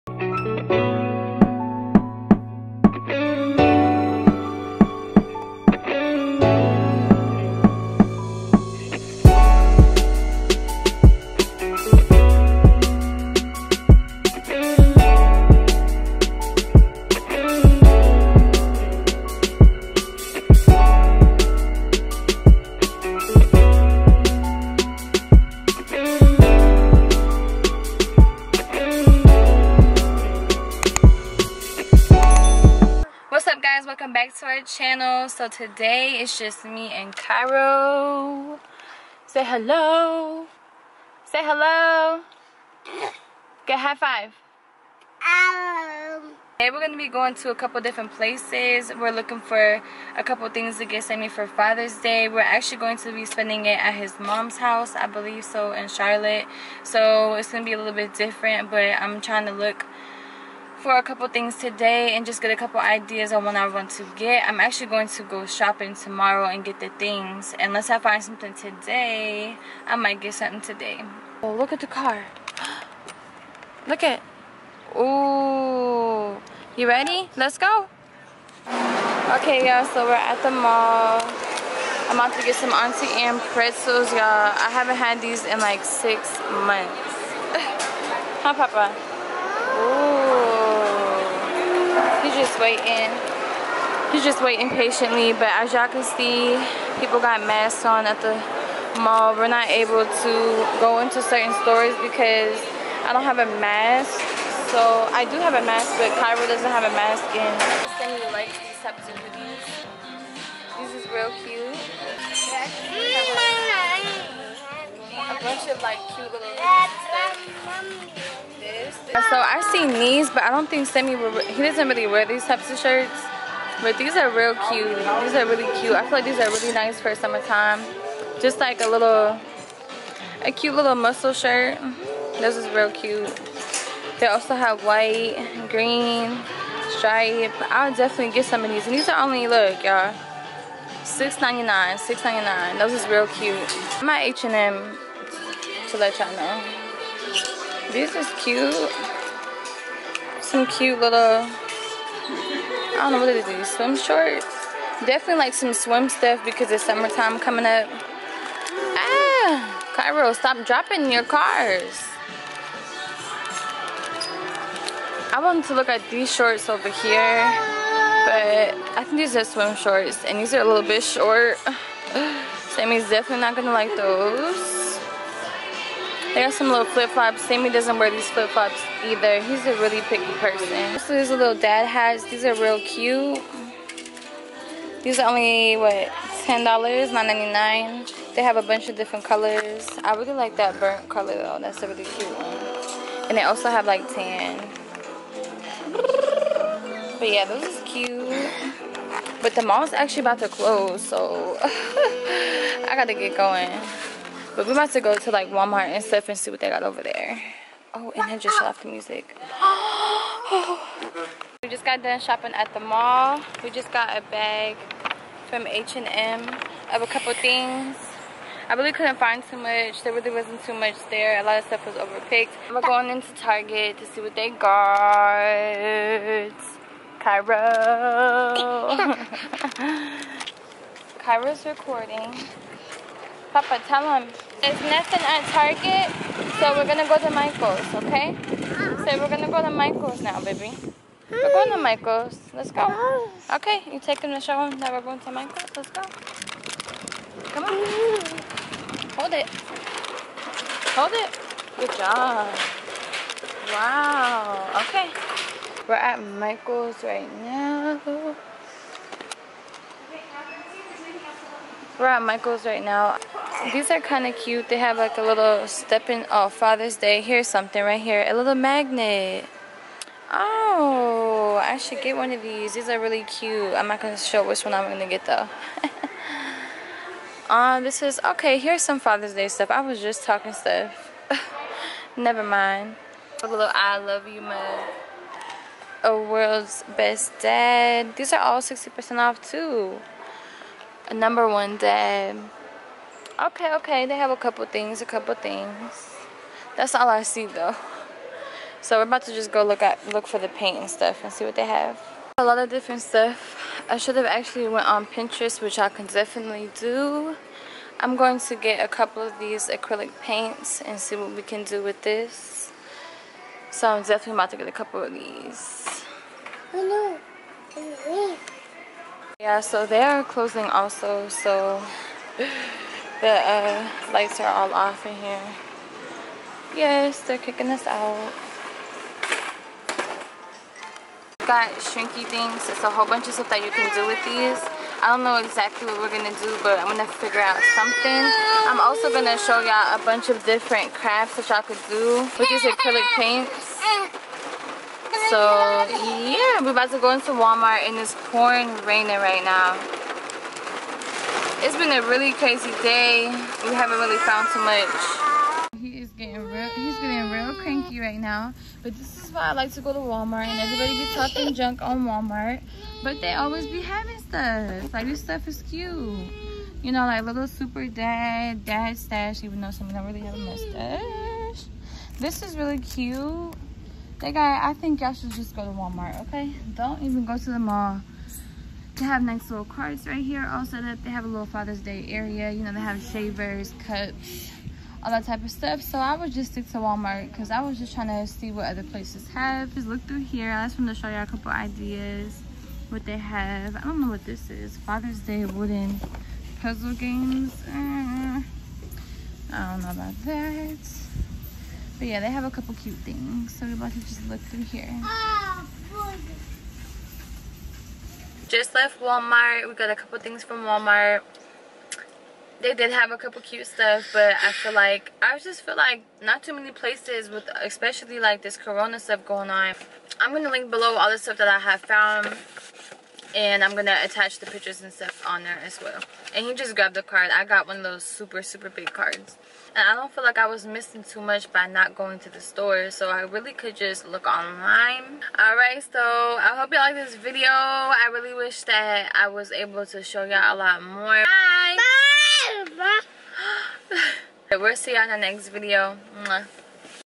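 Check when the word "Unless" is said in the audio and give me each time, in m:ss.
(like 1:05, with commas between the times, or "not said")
1:07.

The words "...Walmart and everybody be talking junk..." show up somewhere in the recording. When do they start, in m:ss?
5:59.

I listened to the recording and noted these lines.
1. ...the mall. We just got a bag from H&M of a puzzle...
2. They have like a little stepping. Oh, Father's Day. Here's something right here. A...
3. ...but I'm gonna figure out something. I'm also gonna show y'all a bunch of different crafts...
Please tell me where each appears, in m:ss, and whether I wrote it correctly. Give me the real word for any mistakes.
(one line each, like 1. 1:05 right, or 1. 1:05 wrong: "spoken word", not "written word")
1. 3:32 wrong: "couple", not "puzzle"
2. 4:24 right
3. 5:36 right.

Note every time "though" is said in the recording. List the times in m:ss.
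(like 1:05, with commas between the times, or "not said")
3:11, 4:35, 4:57, 6:09.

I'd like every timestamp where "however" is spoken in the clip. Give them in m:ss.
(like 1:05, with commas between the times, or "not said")
not said.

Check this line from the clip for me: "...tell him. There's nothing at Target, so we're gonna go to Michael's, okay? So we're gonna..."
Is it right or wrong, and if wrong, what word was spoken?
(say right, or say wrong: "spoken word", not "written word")
right.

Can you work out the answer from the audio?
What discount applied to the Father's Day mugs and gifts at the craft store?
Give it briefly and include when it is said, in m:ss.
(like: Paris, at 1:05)
60% off, at 4:48.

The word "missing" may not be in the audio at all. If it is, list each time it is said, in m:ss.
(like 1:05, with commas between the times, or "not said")
7:10.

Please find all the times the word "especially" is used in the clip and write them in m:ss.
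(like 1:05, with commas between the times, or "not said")
6:57.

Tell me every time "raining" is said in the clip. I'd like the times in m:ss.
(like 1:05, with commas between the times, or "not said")
5:48.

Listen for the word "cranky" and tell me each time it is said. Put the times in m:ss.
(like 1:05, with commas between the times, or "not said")
5:57.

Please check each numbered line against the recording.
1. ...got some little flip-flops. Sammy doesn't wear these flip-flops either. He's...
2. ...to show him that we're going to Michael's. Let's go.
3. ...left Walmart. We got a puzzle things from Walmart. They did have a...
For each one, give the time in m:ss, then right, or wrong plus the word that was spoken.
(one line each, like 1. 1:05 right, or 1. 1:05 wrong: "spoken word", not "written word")
1. 2:56 right
2. 4:04 right
3. 6:48 wrong: "couple", not "puzzle".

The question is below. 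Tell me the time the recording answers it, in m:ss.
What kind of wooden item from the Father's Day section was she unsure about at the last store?
6:35.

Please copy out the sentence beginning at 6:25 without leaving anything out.
So I would just stick to Walmart because I was just trying to see what other places have.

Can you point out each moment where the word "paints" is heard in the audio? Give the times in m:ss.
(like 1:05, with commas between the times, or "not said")
5:00, 5:10, 5:43.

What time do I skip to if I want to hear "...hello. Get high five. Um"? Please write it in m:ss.
0:41.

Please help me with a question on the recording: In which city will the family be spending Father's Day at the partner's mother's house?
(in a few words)
Charlotte.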